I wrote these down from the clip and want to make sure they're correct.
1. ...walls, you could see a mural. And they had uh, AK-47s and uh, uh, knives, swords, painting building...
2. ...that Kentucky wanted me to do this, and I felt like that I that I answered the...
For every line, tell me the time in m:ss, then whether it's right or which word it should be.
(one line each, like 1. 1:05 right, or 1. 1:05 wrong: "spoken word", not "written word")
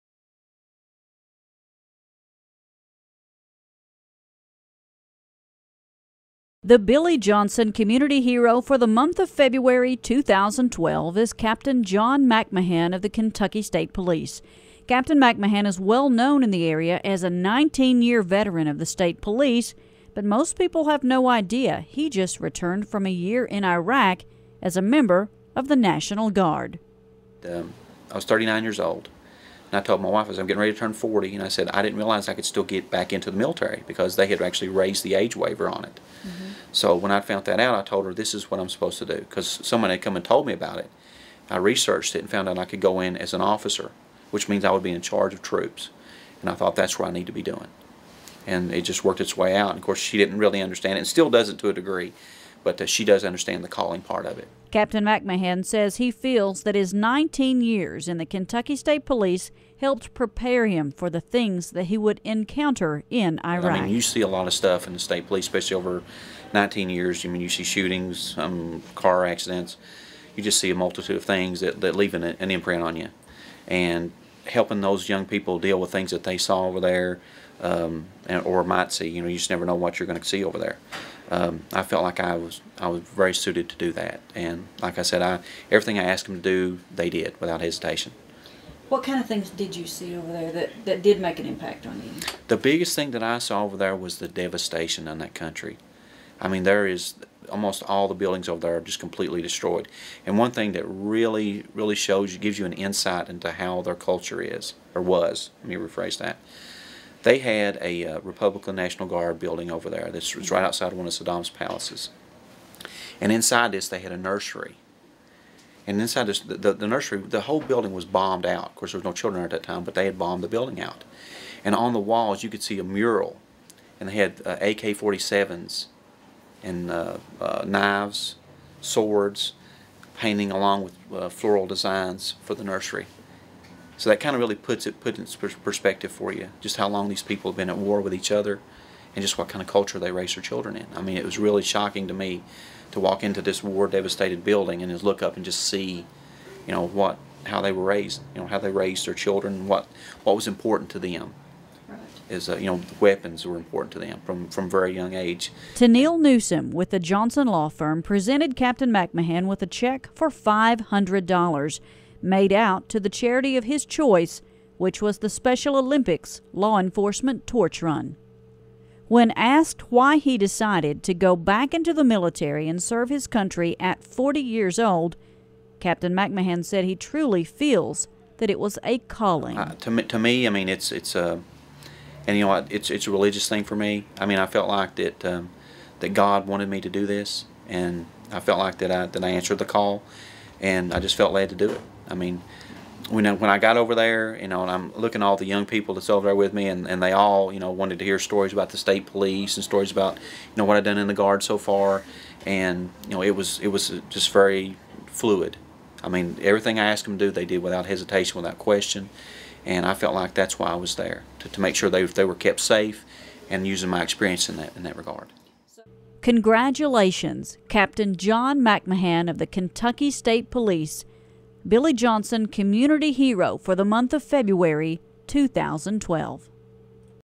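1. 2:01 wrong: "along", not "building"
2. 3:05 wrong: "God", not "Kentucky".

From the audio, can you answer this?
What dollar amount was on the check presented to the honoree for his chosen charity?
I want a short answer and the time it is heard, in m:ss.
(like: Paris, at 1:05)
$500, at 2:40.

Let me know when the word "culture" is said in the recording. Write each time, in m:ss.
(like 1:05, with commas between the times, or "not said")
1:43, 2:19.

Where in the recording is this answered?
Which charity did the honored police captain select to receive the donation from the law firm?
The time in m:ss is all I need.
2:45.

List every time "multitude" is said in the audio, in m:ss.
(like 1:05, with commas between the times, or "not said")
1:10.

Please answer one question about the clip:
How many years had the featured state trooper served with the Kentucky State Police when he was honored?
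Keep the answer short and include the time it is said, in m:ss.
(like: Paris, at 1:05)
19, at 0:17.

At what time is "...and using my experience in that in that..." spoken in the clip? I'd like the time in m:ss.
3:33.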